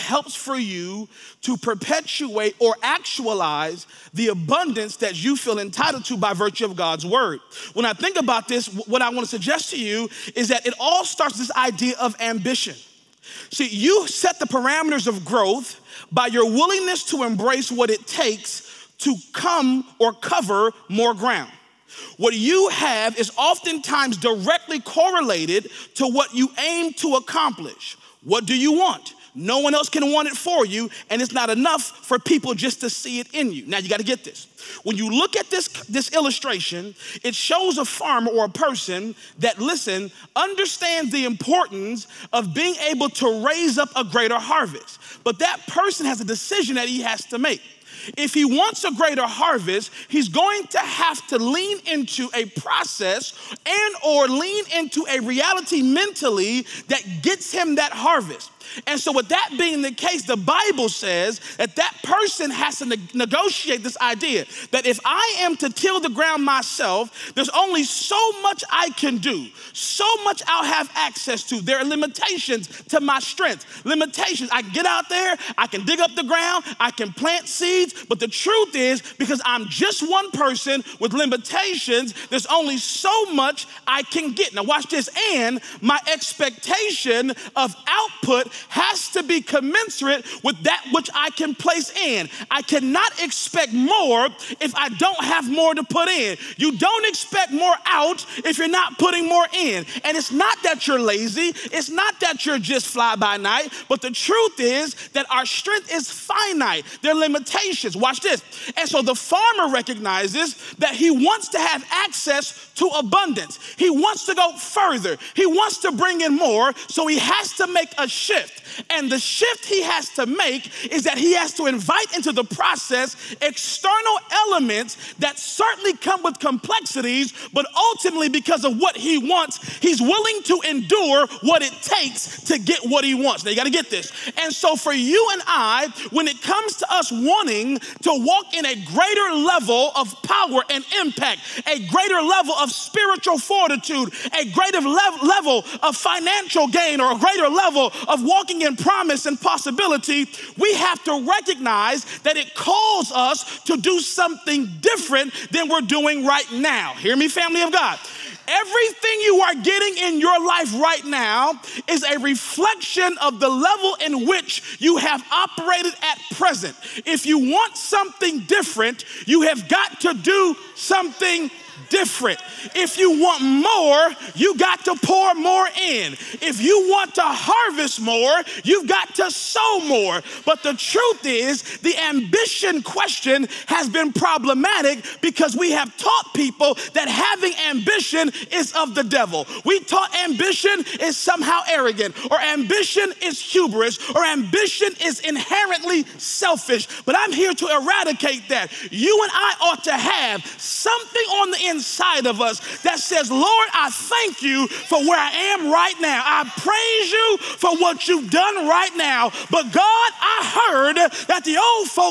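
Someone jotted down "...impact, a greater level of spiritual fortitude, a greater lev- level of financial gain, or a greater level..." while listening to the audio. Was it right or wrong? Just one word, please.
right.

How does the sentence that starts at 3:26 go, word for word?
I praise you for what you've done right now.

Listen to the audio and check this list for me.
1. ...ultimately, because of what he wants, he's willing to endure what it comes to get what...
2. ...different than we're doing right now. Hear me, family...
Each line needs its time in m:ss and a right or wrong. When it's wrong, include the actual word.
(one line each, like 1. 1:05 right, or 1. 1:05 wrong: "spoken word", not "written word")
1. 2:07 wrong: "takes", not "comes"
2. 2:34 right.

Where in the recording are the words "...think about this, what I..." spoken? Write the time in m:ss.
0:07.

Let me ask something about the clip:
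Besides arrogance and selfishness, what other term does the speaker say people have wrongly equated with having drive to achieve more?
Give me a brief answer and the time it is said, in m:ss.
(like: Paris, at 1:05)
Hubris, at 3:13.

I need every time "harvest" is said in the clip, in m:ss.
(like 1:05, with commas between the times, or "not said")
0:44, 0:49, 0:57, 2:57.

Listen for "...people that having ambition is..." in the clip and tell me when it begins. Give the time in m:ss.
3:06.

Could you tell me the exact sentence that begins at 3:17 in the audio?
But I'm here to eradicate that.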